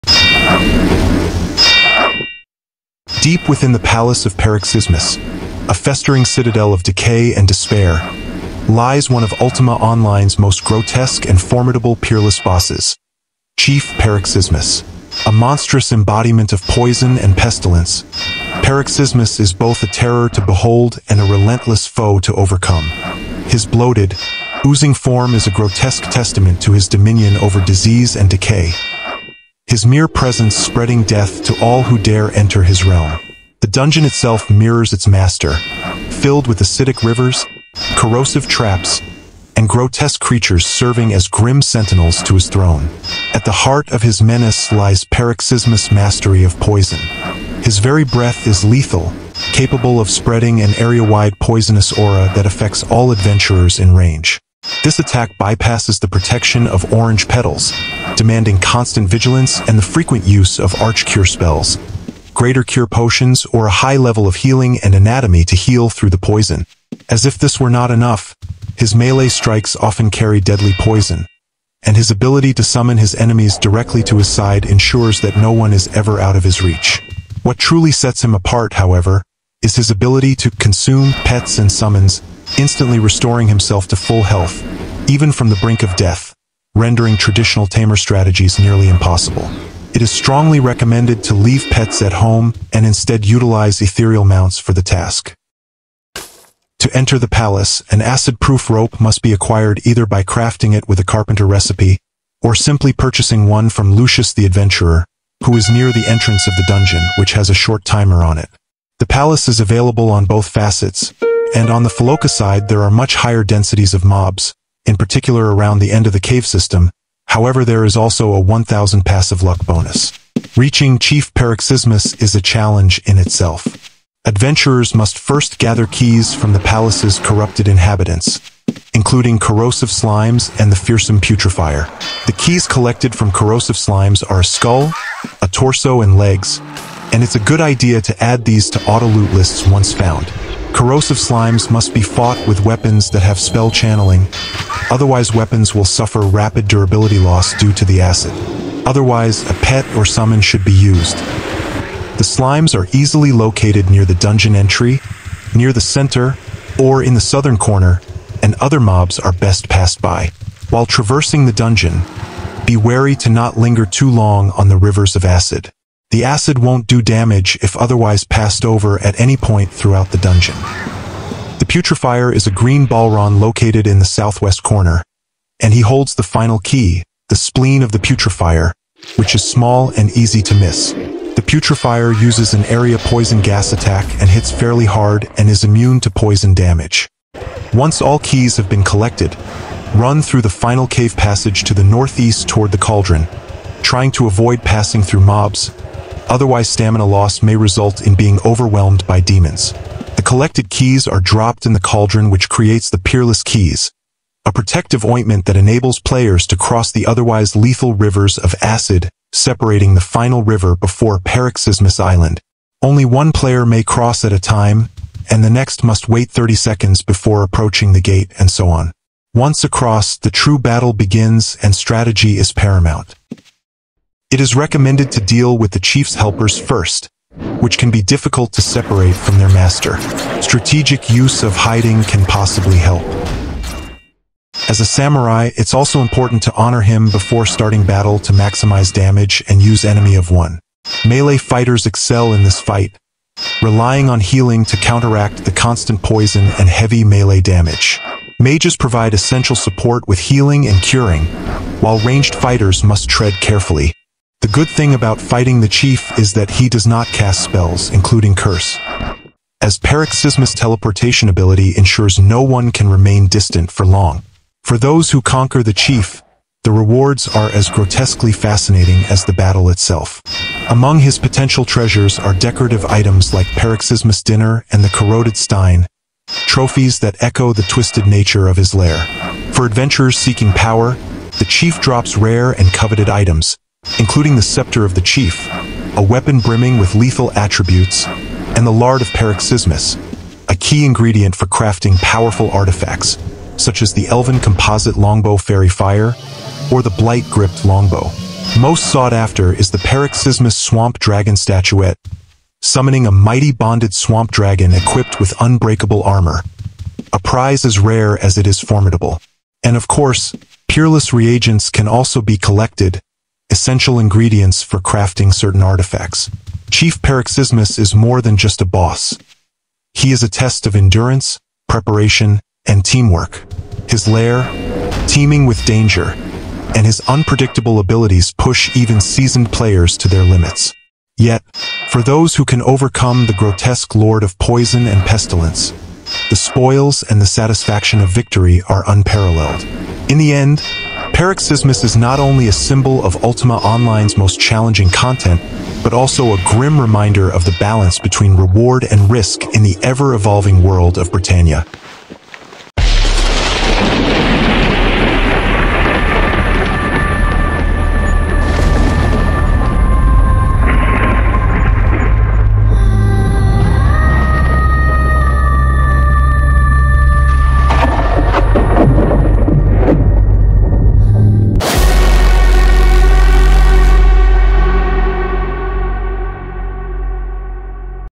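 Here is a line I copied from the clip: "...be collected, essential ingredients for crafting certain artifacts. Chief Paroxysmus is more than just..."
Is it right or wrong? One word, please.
right.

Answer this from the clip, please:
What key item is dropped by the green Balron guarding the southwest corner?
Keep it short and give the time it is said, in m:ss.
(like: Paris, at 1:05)
spleen of the Putrefier, at 2:57.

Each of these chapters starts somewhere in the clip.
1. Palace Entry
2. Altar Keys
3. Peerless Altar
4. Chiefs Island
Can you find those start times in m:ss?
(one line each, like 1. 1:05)
1. 1:36
2. 2:11
3. 3:30
4. 3:43.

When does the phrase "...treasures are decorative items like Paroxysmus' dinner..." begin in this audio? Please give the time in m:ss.
4:31.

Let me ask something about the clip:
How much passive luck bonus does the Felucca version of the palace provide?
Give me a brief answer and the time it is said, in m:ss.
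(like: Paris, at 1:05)
1000, at 1:58.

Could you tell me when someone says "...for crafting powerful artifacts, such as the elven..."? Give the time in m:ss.
4:51.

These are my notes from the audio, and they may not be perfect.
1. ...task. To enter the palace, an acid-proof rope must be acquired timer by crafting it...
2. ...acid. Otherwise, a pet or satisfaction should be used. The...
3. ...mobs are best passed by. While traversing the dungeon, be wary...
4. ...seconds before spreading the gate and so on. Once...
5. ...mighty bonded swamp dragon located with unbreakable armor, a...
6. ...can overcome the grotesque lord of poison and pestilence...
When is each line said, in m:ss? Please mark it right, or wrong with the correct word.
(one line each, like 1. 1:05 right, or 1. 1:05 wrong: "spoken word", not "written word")
1. 1:34 wrong: "either", not "timer"
2. 2:28 wrong: "summon", not "satisfaction"
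3. 2:38 right
4. 3:36 wrong: "approaching", not "spreading"
5. 5:03 wrong: "equipped", not "located"
6. 5:32 right.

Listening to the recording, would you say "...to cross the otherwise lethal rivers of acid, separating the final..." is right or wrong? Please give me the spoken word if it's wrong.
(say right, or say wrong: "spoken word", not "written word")
right.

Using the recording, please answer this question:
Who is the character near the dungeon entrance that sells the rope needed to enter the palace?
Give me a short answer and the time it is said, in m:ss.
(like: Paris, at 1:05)
Lucius the Adventurer, at 1:43.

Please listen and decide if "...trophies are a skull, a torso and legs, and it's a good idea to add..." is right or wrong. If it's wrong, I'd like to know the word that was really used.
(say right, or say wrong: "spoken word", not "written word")
wrong: "slimes", not "trophies".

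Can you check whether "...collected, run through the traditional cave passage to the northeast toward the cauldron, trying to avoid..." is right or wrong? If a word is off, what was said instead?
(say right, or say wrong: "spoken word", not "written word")
wrong: "final", not "traditional".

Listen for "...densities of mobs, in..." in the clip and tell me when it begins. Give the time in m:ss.
1:53.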